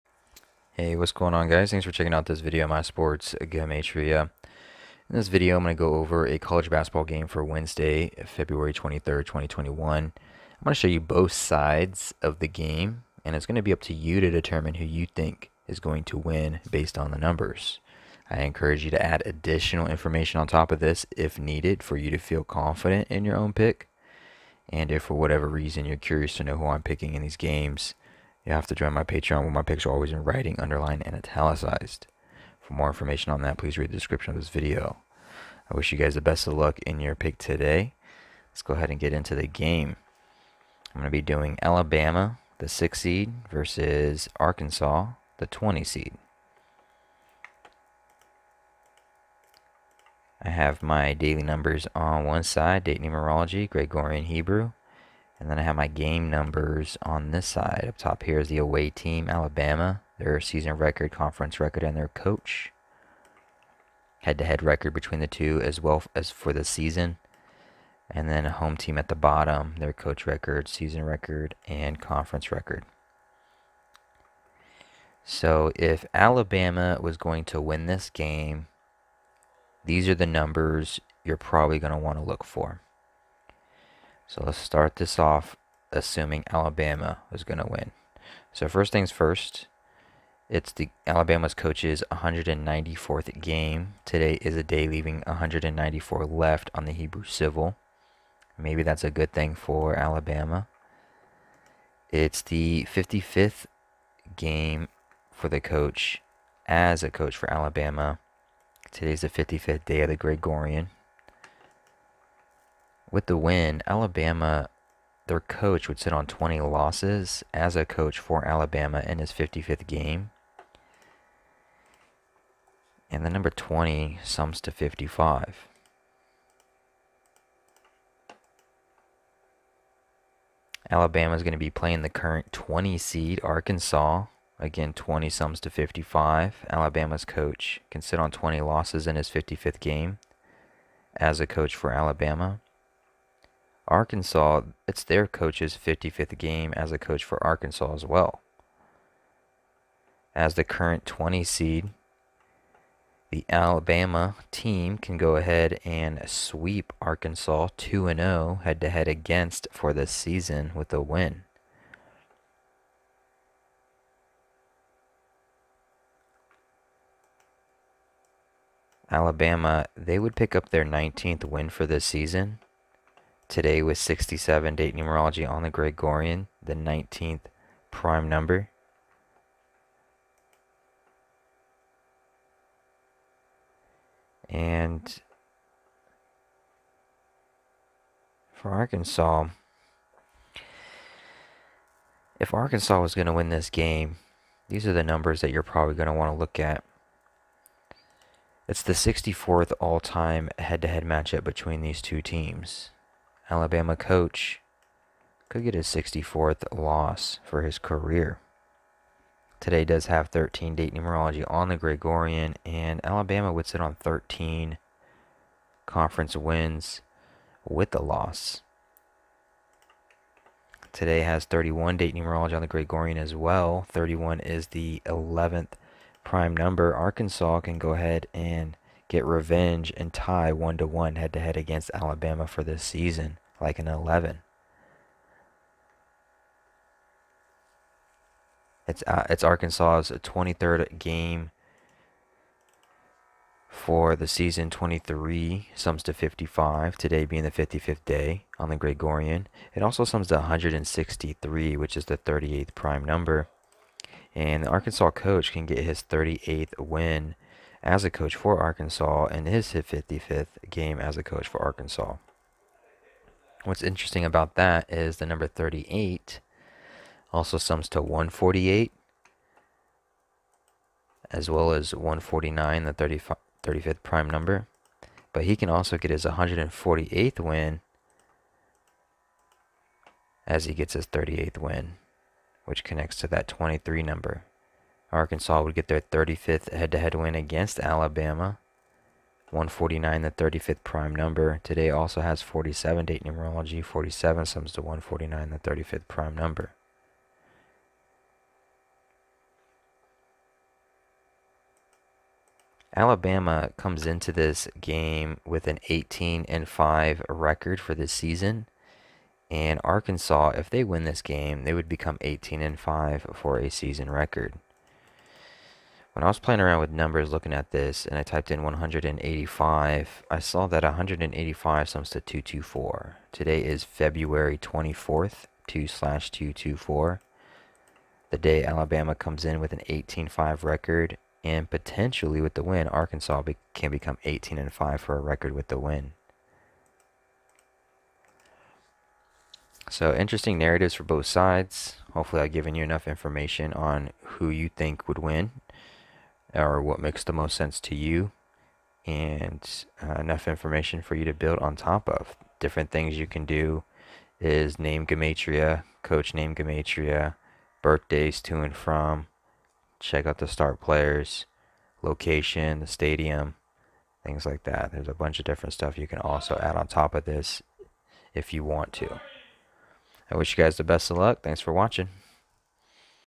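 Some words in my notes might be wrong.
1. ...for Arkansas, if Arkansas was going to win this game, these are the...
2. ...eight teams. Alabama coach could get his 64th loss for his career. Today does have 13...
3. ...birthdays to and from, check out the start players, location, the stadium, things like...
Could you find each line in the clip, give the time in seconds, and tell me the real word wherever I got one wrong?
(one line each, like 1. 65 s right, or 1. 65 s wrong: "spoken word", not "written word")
1. 188 s right
2. 202 s wrong: "two", not "eight"
3. 357 s right.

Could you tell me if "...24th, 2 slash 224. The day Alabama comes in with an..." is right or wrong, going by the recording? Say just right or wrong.
right.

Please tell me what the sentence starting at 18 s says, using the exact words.
I encourage you to add additional information on top of this if needed for you to feel confident in your own pick.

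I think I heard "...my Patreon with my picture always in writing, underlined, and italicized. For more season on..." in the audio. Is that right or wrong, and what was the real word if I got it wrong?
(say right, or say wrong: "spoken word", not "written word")
wrong: "information", not "season".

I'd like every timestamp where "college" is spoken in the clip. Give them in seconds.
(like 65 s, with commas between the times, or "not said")
6 s.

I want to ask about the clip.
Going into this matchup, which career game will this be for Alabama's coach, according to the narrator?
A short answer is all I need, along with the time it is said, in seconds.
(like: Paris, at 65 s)
194th, at 92 s.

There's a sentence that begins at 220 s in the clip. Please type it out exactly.
Today has 31 date numerology on the Gregorian as well.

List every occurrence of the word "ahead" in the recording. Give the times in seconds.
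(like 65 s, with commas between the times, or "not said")
38 s, 155 s, 227 s.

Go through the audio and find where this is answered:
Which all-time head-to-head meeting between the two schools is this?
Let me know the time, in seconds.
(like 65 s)
198 s.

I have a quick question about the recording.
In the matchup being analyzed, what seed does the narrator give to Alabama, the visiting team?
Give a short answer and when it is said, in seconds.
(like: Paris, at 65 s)
6, at 42 s.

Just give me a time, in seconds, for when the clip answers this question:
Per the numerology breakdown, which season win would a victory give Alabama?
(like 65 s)
170 s.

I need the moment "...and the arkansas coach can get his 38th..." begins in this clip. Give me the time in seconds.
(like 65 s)
254 s.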